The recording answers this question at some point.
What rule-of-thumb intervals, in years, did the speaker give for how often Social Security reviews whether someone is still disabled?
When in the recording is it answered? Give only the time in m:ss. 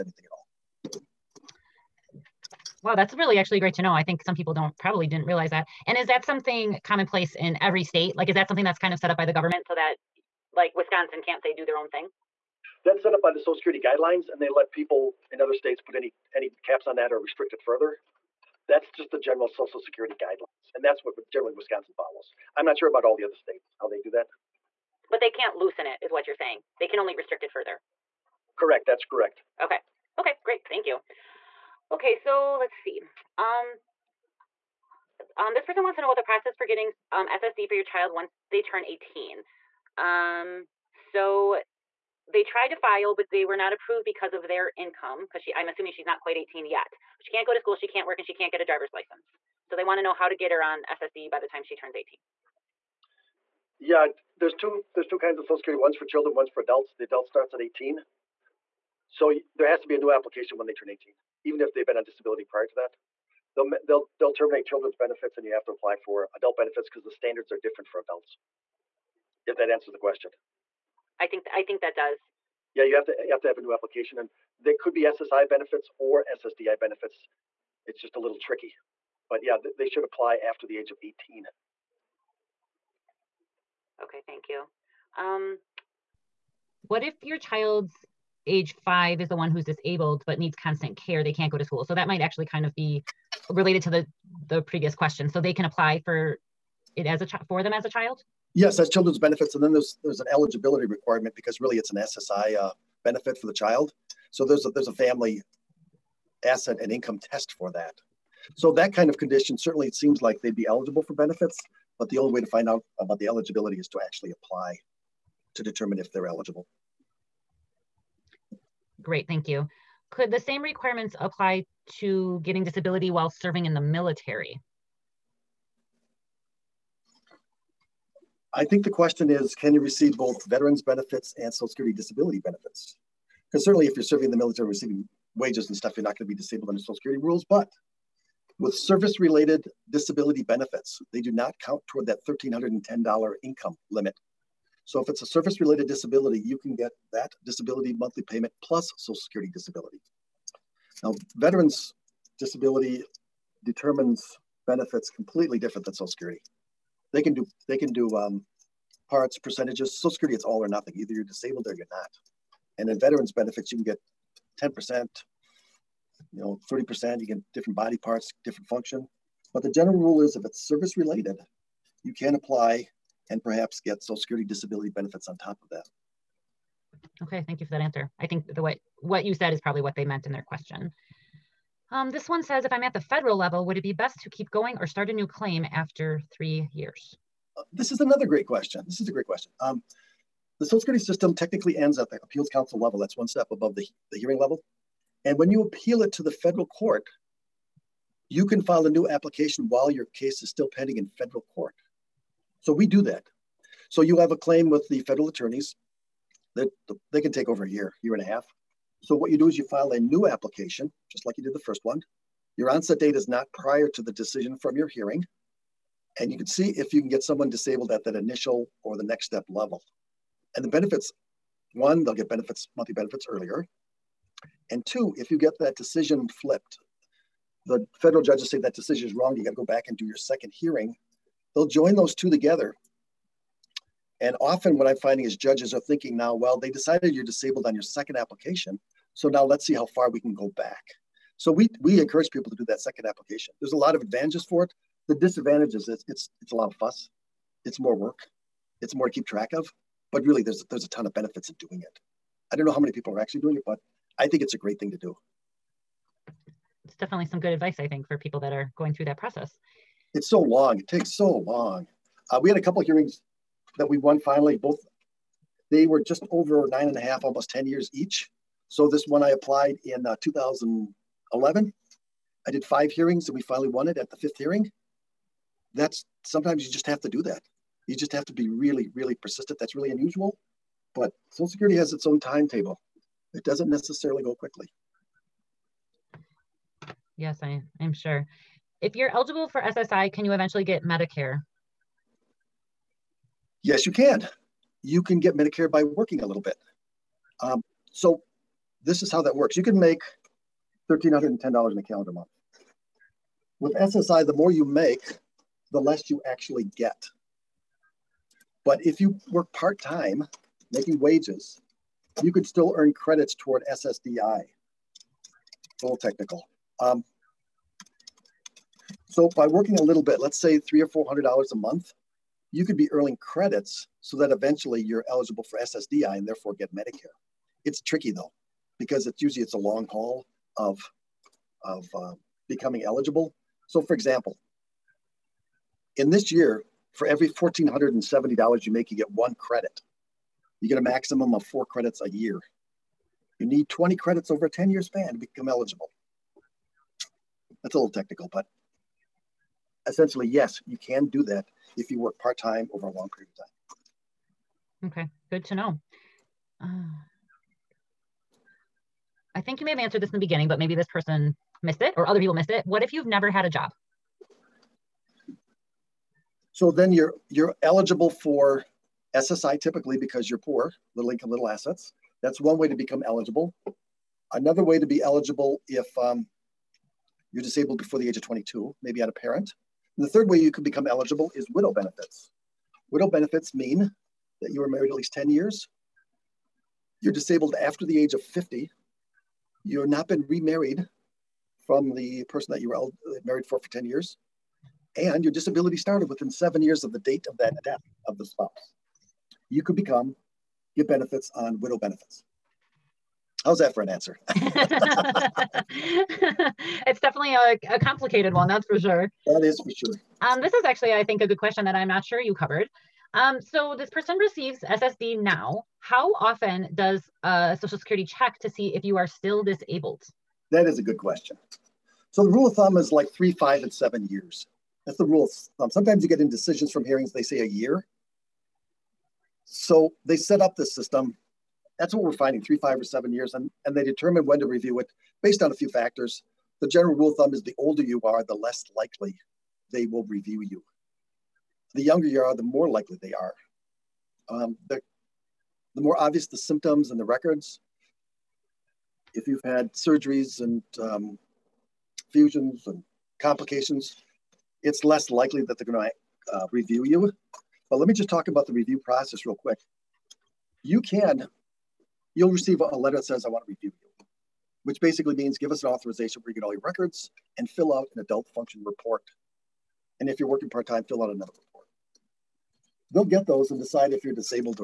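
7:03.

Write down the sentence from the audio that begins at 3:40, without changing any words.
And the benefits one, they'll get benefits, monthly benefits earlier.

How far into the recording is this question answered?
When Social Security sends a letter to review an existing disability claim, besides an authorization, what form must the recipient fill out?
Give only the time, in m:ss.
7:48.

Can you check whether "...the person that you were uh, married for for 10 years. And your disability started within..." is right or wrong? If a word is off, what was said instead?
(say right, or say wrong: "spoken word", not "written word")
right.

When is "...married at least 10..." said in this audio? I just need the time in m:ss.
6:24.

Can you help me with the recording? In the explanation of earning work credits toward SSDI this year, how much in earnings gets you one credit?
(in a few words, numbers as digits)
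$1,470.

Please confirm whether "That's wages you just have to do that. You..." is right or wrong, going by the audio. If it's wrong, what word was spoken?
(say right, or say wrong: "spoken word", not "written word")
wrong: "sometimes", not "wages".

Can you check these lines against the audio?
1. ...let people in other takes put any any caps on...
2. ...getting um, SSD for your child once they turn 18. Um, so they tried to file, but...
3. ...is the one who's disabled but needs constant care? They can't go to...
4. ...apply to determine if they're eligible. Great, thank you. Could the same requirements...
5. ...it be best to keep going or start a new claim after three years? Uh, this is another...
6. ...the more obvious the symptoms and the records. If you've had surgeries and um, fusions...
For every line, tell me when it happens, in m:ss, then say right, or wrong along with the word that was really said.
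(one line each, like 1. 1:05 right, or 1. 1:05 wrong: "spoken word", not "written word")
1. 0:14 wrong: "states", not "takes"
2. 0:36 right
3. 1:29 right
4. 1:54 right
5. 3:03 right
6. 7:25 right.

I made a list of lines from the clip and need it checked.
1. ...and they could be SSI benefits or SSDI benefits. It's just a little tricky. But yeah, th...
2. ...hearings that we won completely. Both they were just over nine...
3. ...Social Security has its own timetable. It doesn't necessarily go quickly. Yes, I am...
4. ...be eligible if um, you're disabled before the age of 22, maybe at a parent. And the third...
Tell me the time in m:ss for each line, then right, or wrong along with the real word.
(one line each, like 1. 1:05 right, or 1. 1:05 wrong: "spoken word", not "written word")
1. 1:14 right
2. 4:22 wrong: "finally", not "completely"
3. 4:41 right
4. 6:14 right.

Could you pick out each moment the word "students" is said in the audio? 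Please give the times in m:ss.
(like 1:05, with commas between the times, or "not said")
not said.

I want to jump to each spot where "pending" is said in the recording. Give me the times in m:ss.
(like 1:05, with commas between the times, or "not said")
3:20.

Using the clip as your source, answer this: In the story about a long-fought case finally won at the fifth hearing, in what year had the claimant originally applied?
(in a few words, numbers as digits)
2011.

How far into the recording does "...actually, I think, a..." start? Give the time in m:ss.
6:50.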